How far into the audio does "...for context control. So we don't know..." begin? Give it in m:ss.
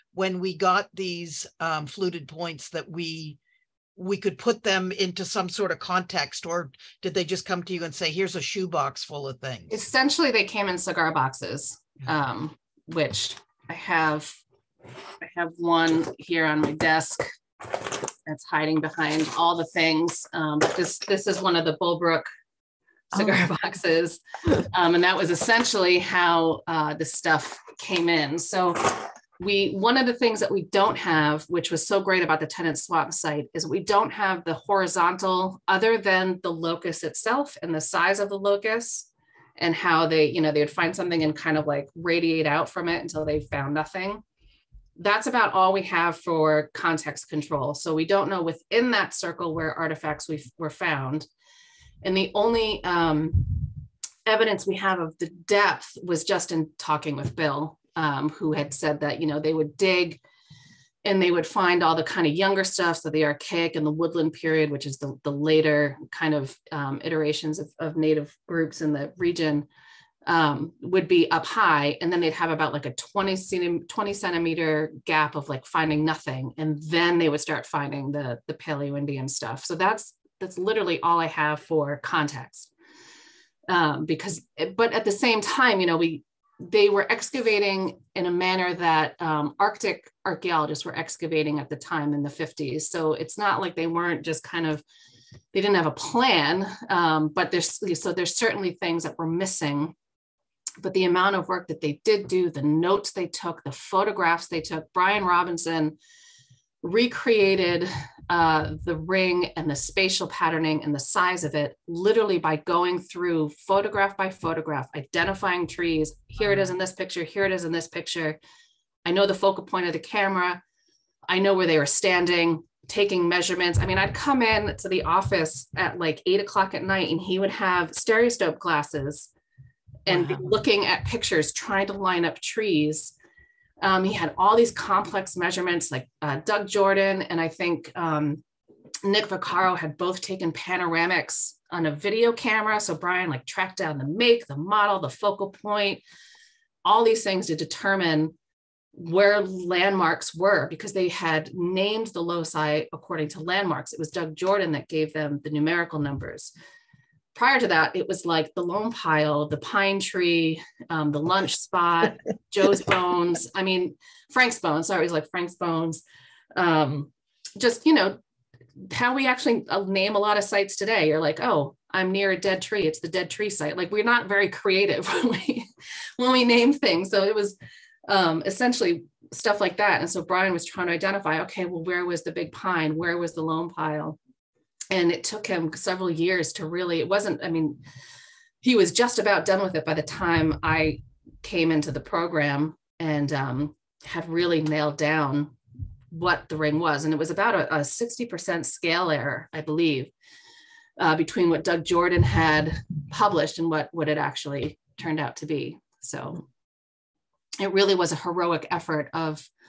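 0:46.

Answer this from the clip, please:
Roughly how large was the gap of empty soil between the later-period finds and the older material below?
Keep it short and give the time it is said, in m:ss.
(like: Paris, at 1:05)
20 centimeters, at 1:13.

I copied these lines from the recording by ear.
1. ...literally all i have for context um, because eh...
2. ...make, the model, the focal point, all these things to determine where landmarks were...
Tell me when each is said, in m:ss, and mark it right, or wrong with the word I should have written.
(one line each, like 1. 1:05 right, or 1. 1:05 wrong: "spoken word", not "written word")
1. 1:20 right
2. 2:24 right.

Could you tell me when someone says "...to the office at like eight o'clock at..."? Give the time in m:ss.
2:04.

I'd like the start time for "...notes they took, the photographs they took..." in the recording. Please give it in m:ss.
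1:42.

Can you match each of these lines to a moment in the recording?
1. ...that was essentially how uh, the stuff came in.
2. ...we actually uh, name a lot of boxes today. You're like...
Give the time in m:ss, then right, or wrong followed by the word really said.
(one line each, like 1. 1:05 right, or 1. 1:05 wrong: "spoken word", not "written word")
1. 0:25 right
2. 2:49 wrong: "sites", not "boxes".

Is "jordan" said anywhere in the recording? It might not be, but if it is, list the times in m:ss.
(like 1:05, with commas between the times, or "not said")
2:16, 2:34, 3:21.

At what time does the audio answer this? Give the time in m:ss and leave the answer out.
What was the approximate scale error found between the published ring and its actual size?
3:17.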